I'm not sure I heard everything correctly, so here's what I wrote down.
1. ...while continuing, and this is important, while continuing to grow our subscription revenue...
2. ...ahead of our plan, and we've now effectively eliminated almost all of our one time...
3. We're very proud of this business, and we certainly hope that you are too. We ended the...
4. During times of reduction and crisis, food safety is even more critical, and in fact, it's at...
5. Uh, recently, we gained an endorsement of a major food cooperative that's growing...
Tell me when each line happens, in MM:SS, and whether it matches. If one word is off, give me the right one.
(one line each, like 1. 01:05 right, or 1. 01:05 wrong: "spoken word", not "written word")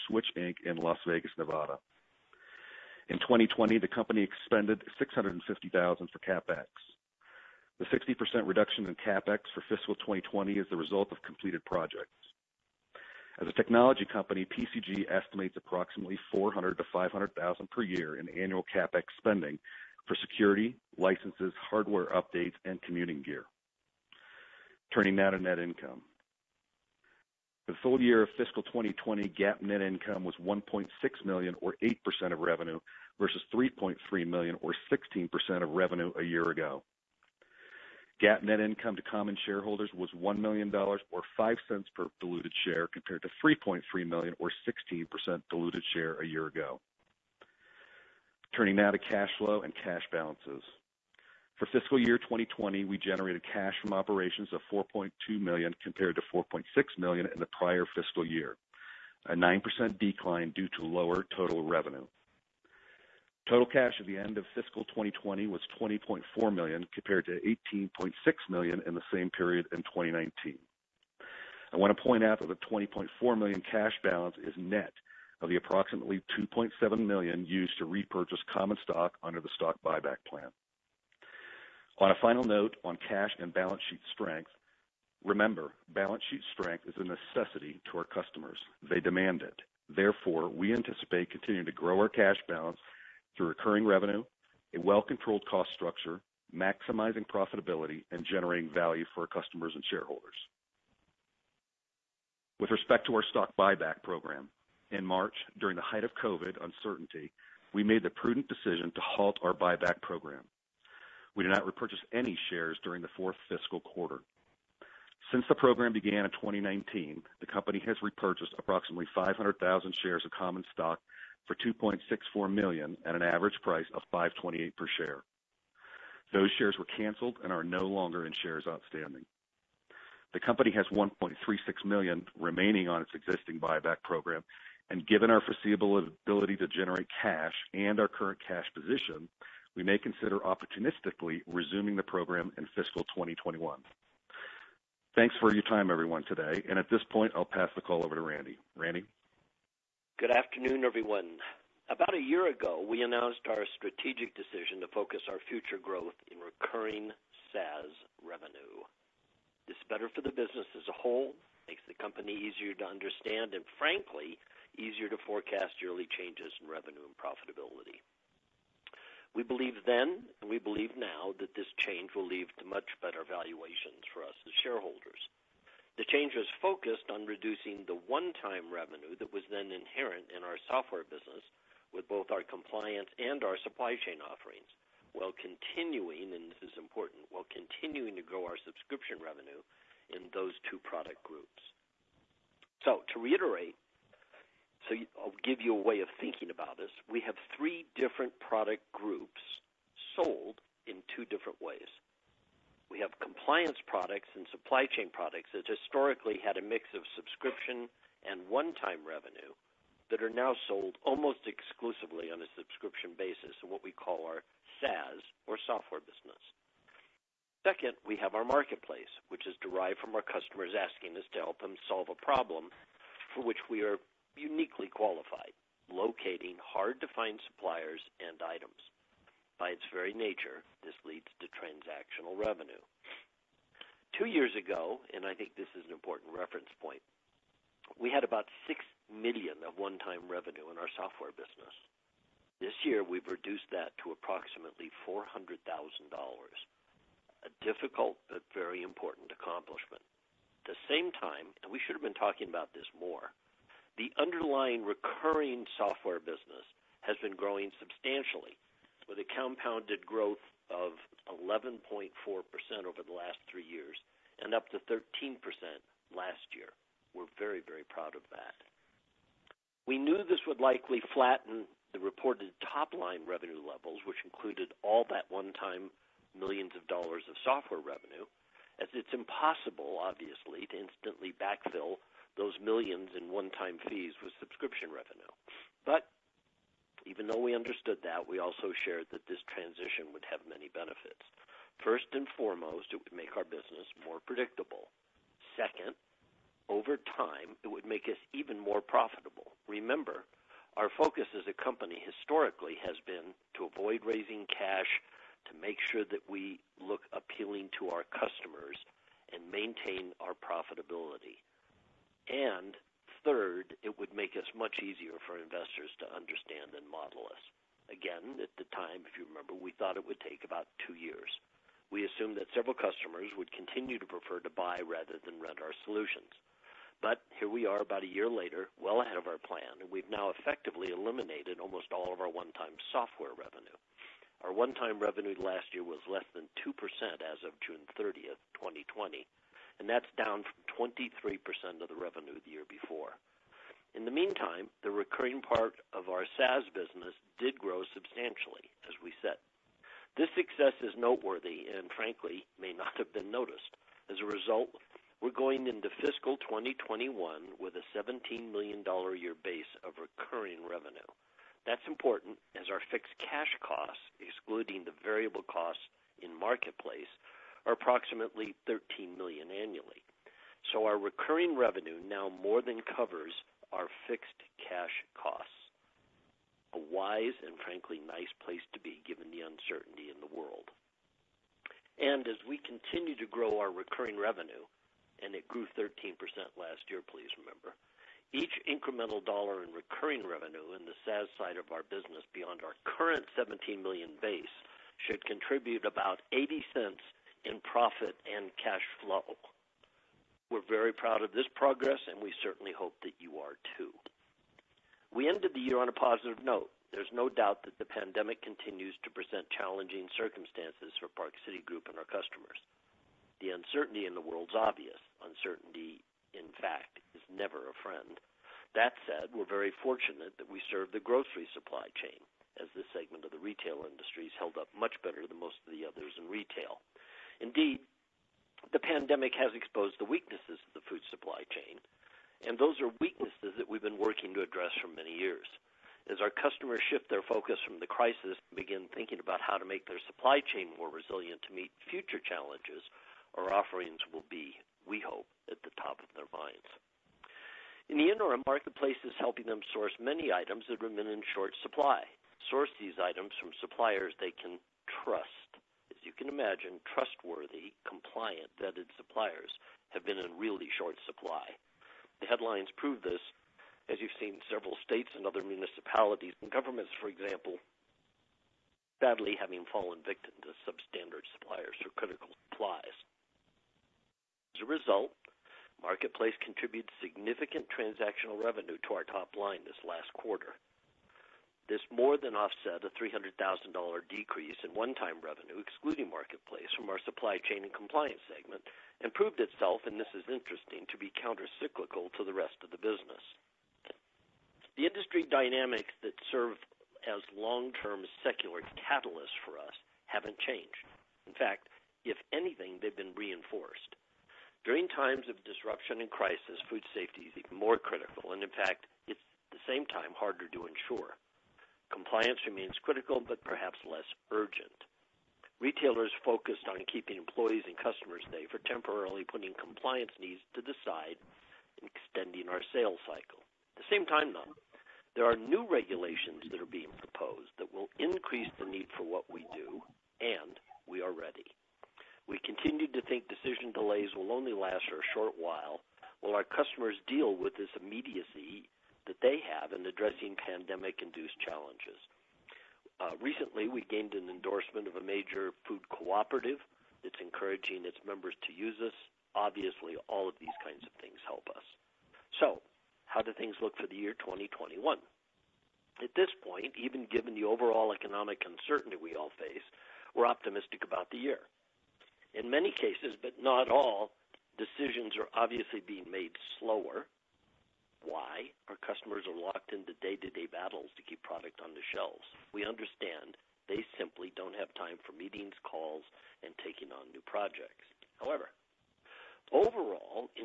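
1. 03:05 right
2. 05:29 right
3. 06:40 wrong: "progress", not "business"
4. 08:24 wrong: "disruption", not "reduction"
5. 09:03 wrong: "encouraging", not "growing".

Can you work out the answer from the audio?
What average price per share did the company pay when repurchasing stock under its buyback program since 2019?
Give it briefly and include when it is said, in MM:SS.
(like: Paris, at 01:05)
5.28, at 02:04.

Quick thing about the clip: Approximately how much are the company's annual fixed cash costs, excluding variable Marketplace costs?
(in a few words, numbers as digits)
$13 million.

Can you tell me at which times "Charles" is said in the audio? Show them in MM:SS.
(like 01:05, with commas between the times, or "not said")
not said.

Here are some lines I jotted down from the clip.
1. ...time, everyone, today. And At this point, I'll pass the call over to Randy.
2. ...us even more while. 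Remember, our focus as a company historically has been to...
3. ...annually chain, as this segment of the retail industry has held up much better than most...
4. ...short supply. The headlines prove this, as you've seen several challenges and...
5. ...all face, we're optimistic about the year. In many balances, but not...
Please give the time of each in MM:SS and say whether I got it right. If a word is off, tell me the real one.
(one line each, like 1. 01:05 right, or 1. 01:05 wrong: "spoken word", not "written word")
1. 02:25 right
2. 04:58 wrong: "profitable", not "while"
3. 07:01 wrong: "supply", not "annually"
4. 07:40 wrong: "states", not "challenges"
5. 09:19 wrong: "cases", not "balances".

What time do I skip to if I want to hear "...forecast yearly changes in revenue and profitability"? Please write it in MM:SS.
02:45.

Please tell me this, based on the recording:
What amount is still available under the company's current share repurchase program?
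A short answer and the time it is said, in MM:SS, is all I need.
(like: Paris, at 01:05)
$1.36, at 02:10.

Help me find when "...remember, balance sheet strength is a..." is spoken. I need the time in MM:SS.
01:25.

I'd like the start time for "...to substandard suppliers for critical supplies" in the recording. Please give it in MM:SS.
07:50.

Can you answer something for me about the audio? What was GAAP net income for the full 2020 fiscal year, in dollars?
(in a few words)
$1.6 million.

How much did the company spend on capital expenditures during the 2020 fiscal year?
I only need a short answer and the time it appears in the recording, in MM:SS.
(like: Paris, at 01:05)
$650,000, at 00:04.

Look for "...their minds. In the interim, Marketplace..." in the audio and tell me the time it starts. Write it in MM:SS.
07:26.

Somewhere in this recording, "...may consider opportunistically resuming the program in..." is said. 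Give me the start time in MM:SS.
02:19.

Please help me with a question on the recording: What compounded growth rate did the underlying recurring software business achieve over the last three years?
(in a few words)
11.4%.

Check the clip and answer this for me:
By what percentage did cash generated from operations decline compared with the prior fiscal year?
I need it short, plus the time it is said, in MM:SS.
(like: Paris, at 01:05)
9%, at 00:59.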